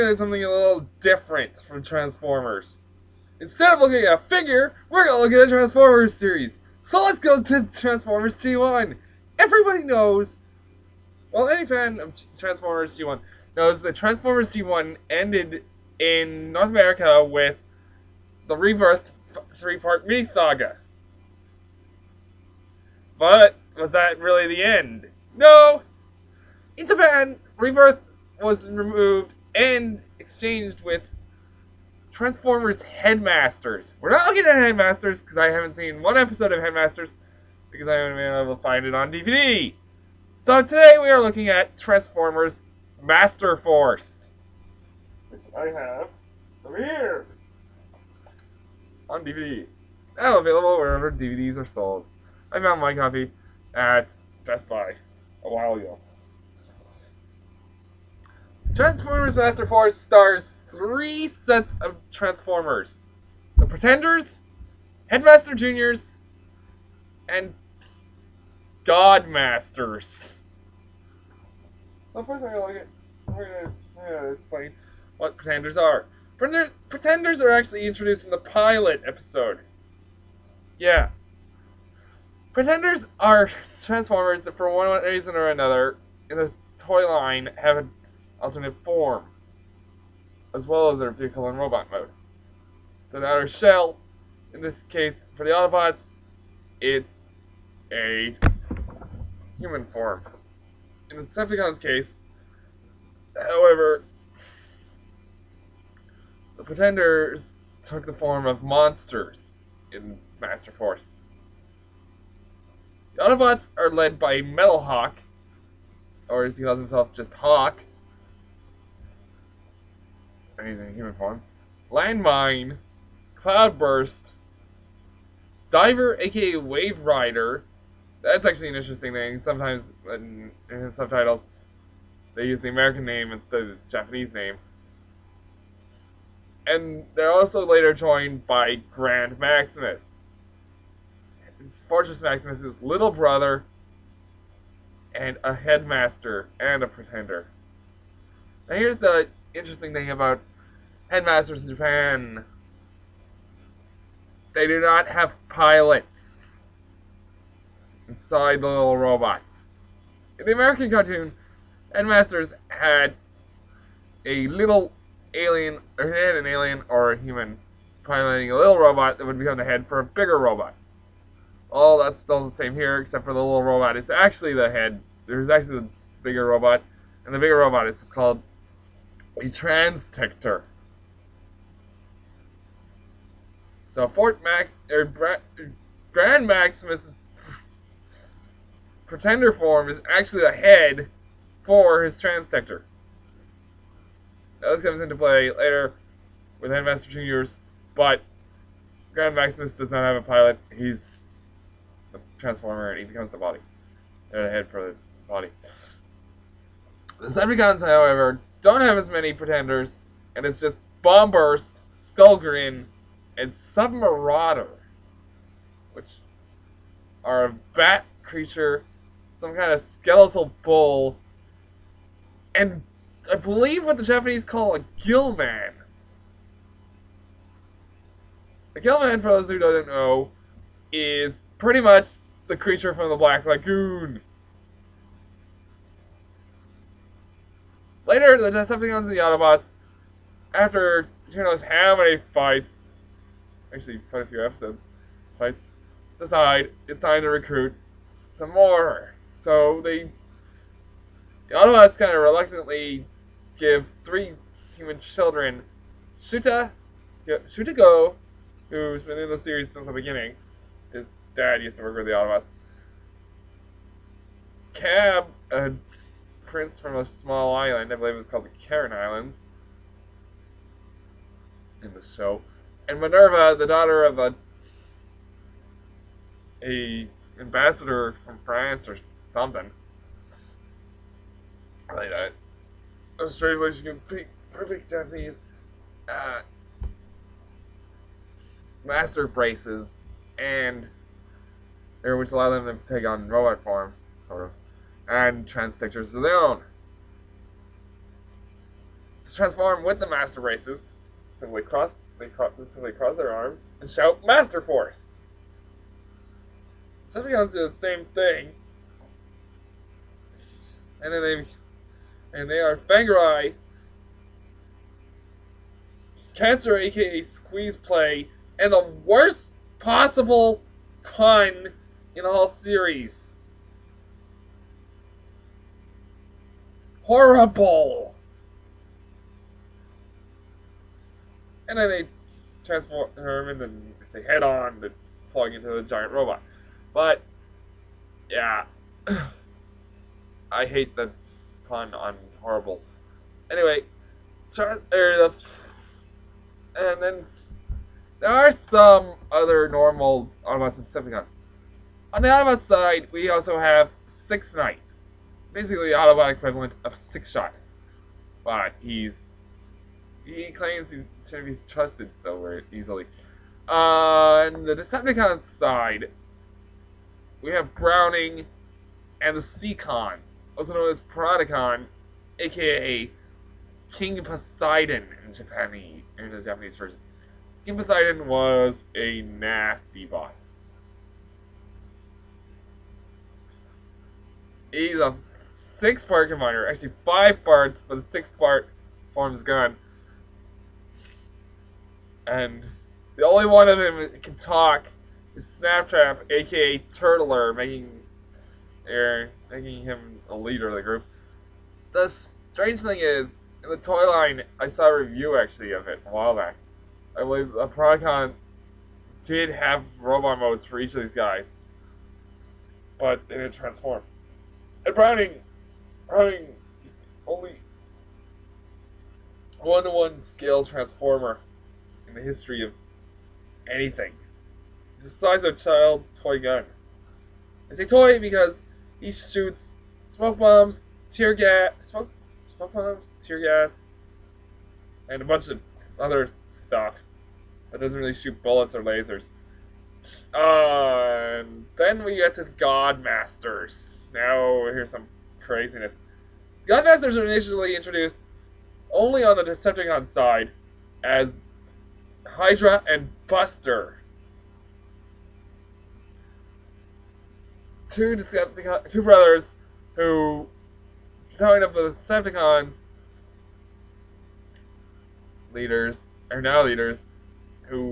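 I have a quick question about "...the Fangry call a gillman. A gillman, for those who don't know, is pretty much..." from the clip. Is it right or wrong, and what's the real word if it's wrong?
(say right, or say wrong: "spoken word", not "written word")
wrong: "Japanese", not "Fangry".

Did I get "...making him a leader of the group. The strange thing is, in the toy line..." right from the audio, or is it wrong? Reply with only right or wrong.
right.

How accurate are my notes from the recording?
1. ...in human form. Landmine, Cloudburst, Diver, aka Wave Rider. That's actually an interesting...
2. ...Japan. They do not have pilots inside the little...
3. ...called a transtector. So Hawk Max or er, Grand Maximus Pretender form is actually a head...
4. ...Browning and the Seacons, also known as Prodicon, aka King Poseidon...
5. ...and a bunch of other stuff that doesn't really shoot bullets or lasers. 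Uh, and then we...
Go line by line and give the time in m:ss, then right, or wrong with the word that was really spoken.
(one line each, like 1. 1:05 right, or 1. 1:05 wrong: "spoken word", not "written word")
1. 2:00 right
2. 2:31 right
3. 2:58 wrong: "Fort", not "Hawk"
4. 6:07 right
5. 7:15 right.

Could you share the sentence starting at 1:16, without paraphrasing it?
Pretenders are actually introduced in the pilot episode.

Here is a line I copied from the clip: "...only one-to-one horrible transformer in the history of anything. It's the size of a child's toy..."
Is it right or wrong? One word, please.
wrong.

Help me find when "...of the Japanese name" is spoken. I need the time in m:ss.
2:13.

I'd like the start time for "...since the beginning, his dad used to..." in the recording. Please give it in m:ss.
4:19.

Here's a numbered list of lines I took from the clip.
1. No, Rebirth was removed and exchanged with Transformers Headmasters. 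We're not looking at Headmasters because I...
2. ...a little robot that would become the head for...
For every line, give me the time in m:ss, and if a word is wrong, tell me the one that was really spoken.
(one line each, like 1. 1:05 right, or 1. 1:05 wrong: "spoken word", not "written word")
1. 0:25 right
2. 2:48 right.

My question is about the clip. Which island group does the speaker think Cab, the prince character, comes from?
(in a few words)
Karen Islands.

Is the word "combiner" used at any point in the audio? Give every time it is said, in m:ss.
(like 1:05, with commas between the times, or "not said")
6:26.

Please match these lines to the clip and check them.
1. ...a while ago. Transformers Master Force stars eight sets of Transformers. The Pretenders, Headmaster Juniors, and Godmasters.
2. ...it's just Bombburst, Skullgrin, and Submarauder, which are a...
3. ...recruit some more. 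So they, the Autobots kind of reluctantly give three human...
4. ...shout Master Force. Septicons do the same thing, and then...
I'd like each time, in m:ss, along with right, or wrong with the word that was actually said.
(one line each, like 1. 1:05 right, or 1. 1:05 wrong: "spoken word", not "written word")
1. 0:55 wrong: "three", not "eight"
2. 3:30 right
3. 4:07 right
4. 5:03 right.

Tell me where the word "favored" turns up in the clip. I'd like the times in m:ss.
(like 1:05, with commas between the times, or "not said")
not said.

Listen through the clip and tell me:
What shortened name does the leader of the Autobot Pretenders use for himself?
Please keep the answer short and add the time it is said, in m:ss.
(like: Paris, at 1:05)
Hawk, at 1:57.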